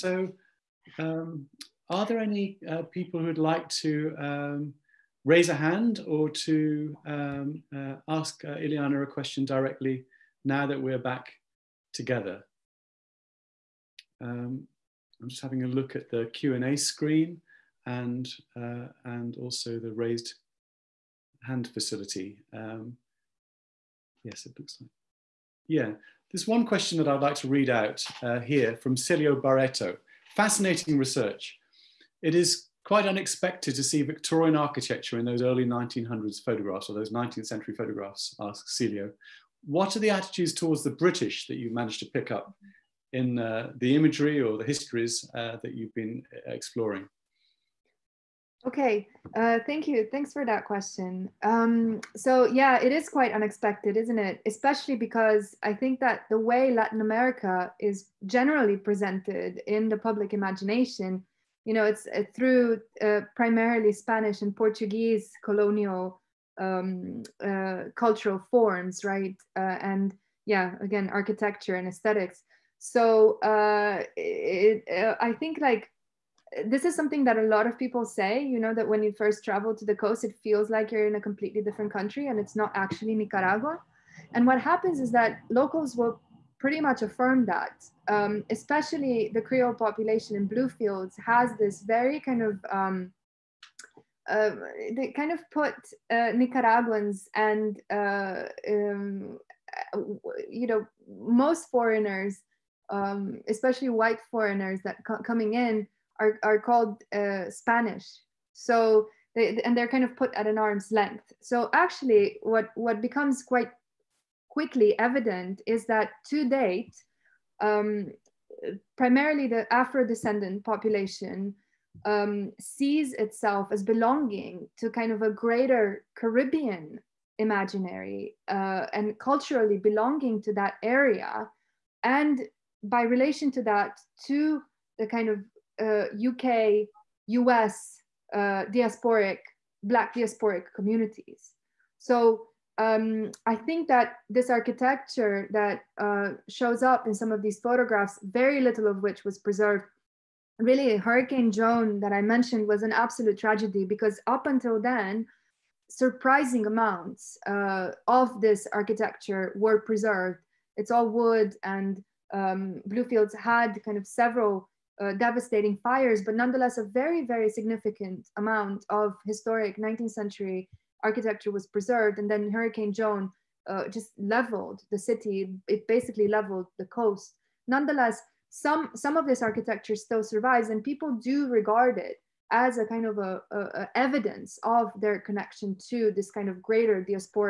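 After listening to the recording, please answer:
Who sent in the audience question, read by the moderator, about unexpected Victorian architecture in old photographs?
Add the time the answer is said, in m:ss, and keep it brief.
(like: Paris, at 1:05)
Celio Barreto, at 0:28.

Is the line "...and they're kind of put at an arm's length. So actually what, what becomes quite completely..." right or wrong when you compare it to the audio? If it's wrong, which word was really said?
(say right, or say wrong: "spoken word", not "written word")
wrong: "quickly", not "completely".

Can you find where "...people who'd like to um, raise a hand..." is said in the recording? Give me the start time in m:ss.
0:02.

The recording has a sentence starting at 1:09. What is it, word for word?
Uh, and yeah, again, architecture and aesthetics.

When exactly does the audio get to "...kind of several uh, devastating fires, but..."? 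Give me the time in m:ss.
2:43.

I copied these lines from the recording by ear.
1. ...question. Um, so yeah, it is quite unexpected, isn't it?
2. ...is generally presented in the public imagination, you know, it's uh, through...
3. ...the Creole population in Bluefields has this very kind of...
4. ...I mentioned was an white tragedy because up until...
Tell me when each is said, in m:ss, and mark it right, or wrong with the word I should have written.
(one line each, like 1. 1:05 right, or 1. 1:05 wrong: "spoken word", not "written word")
1. 0:50 right
2. 0:57 right
3. 1:29 right
4. 2:32 wrong: "absolute", not "white".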